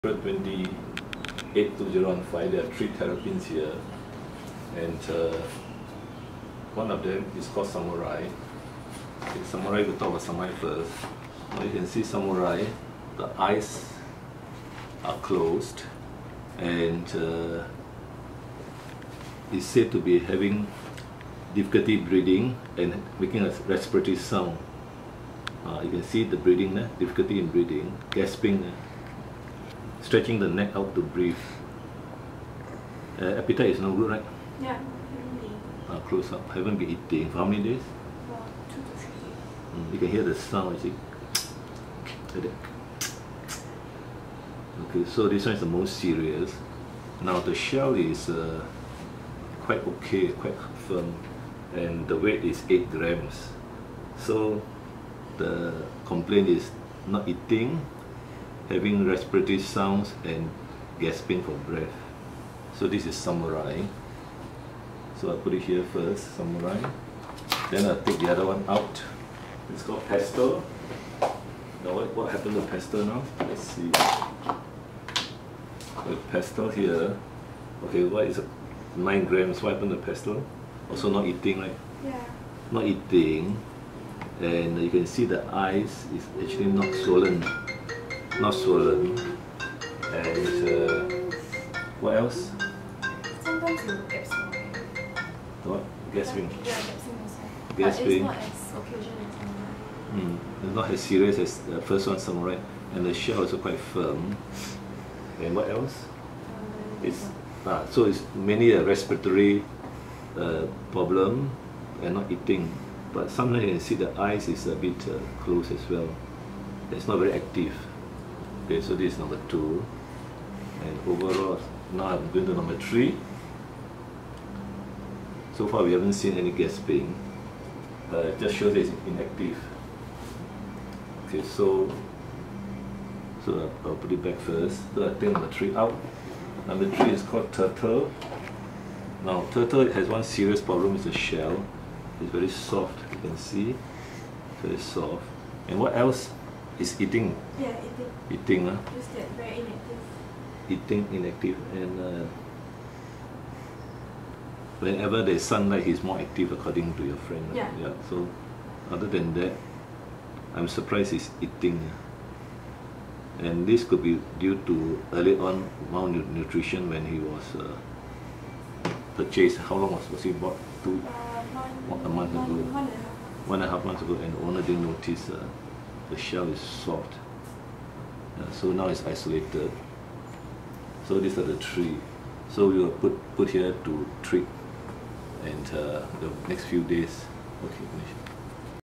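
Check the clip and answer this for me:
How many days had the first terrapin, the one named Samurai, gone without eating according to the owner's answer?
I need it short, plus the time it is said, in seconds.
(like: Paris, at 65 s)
2 to 3 days, at 38 s.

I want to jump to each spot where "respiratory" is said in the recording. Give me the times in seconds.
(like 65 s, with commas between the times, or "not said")
23 s, 59 s, 108 s.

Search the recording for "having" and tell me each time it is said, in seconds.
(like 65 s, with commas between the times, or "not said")
20 s, 58 s.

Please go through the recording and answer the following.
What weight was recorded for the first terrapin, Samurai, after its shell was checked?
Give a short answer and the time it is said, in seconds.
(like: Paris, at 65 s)
8 grams, at 52 s.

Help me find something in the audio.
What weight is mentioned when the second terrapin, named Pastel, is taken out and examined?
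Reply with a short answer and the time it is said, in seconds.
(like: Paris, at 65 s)
9 grams, at 78 s.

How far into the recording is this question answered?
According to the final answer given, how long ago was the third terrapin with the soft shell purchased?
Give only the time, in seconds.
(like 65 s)
173 s.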